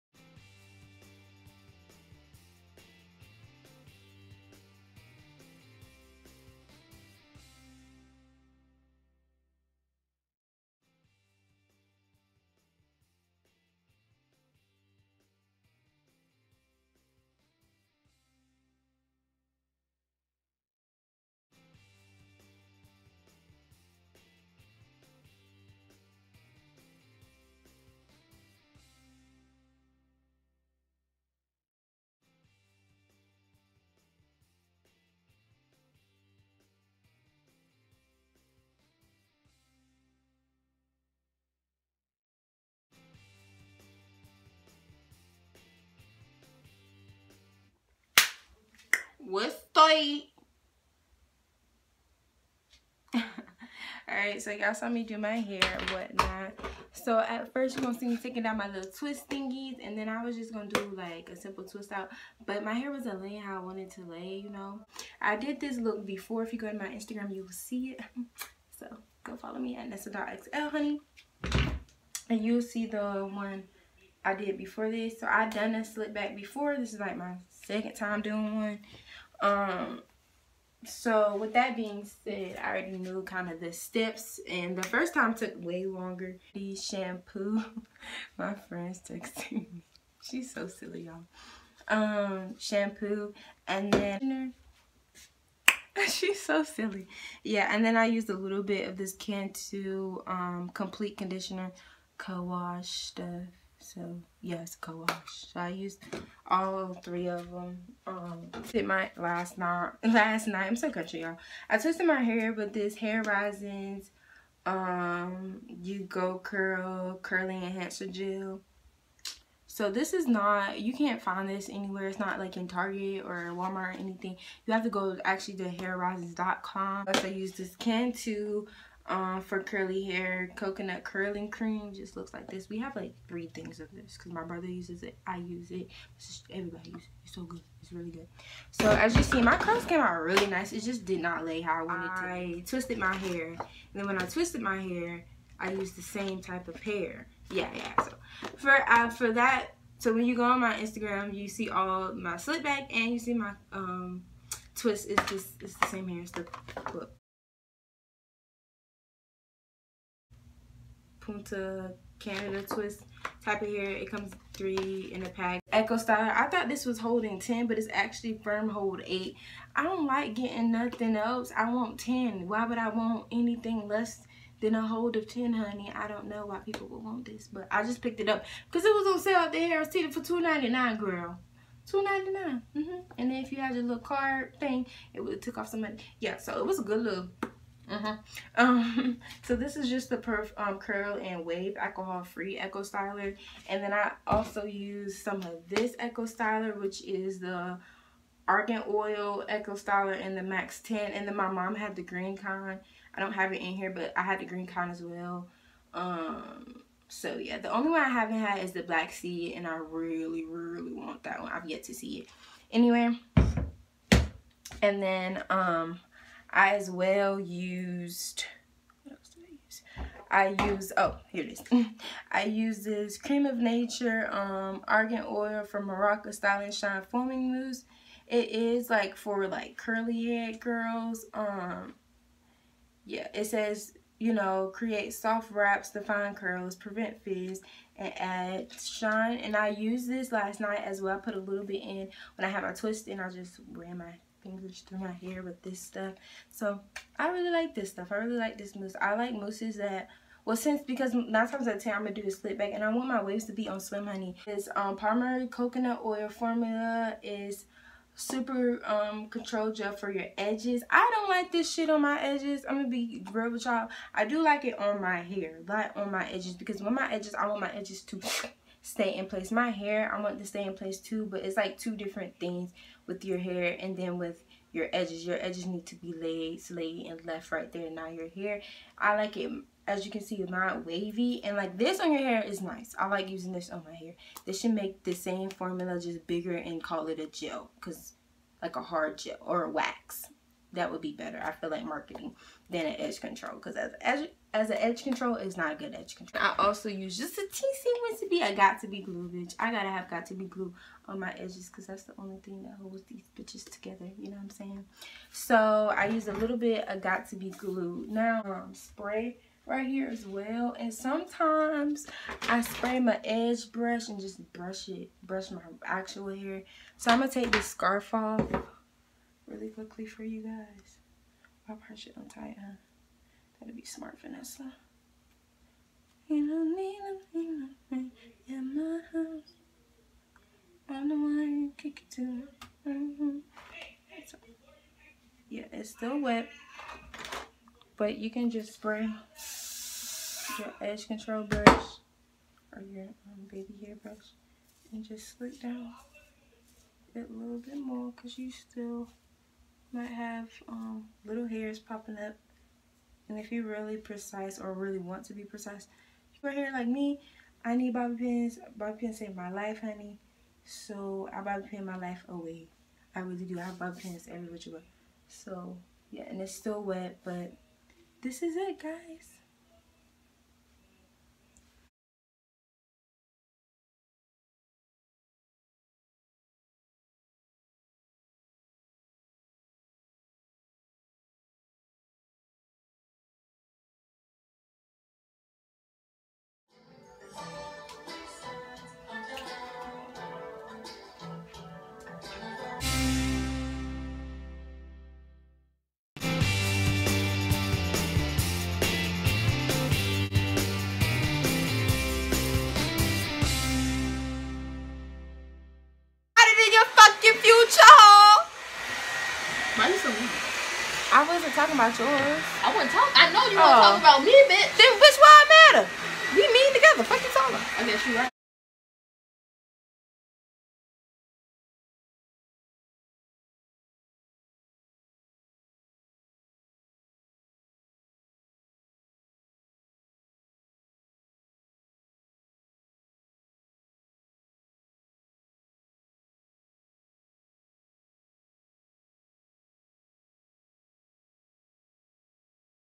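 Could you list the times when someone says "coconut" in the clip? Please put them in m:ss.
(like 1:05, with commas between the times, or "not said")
2:10, 4:15.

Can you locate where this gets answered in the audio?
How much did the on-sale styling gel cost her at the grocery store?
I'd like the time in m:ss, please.
3:00.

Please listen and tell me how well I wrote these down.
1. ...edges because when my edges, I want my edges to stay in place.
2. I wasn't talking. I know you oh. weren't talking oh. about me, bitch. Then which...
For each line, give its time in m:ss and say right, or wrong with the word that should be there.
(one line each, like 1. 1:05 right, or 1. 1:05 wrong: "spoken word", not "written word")
1. 4:26 right
2. 6:52 right.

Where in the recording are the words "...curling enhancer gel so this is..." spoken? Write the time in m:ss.
1:57.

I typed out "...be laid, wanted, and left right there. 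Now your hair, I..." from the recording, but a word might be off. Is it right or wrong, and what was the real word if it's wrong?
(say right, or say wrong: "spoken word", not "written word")
wrong: "slayed", not "wanted".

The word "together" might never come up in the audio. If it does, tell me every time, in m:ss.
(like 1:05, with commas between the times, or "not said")
5:03, 6:56.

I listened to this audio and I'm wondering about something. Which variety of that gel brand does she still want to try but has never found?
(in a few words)
Black Seed.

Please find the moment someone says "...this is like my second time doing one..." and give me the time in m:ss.
1:16.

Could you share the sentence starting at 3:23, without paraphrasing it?
I don't have it in here, but I had the Green Con as well.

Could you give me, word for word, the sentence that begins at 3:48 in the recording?
It is like for like curly head girls.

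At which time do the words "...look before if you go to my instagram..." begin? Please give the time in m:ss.
1:05.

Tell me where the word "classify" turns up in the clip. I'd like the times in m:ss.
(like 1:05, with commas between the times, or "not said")
not said.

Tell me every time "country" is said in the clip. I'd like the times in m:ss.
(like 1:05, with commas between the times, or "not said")
1:50.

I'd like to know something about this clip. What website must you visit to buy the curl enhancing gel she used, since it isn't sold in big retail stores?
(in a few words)
hairrisins.com.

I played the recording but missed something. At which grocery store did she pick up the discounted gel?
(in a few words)
Harris Teeter.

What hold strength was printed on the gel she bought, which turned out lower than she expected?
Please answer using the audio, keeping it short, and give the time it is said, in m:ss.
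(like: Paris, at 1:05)
8, at 2:48.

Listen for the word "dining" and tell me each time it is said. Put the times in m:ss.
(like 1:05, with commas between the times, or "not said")
not said.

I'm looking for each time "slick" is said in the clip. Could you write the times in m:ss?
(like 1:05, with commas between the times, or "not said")
1:15, 2:32, 4:12, 5:45.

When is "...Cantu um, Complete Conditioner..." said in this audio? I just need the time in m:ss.
1:39.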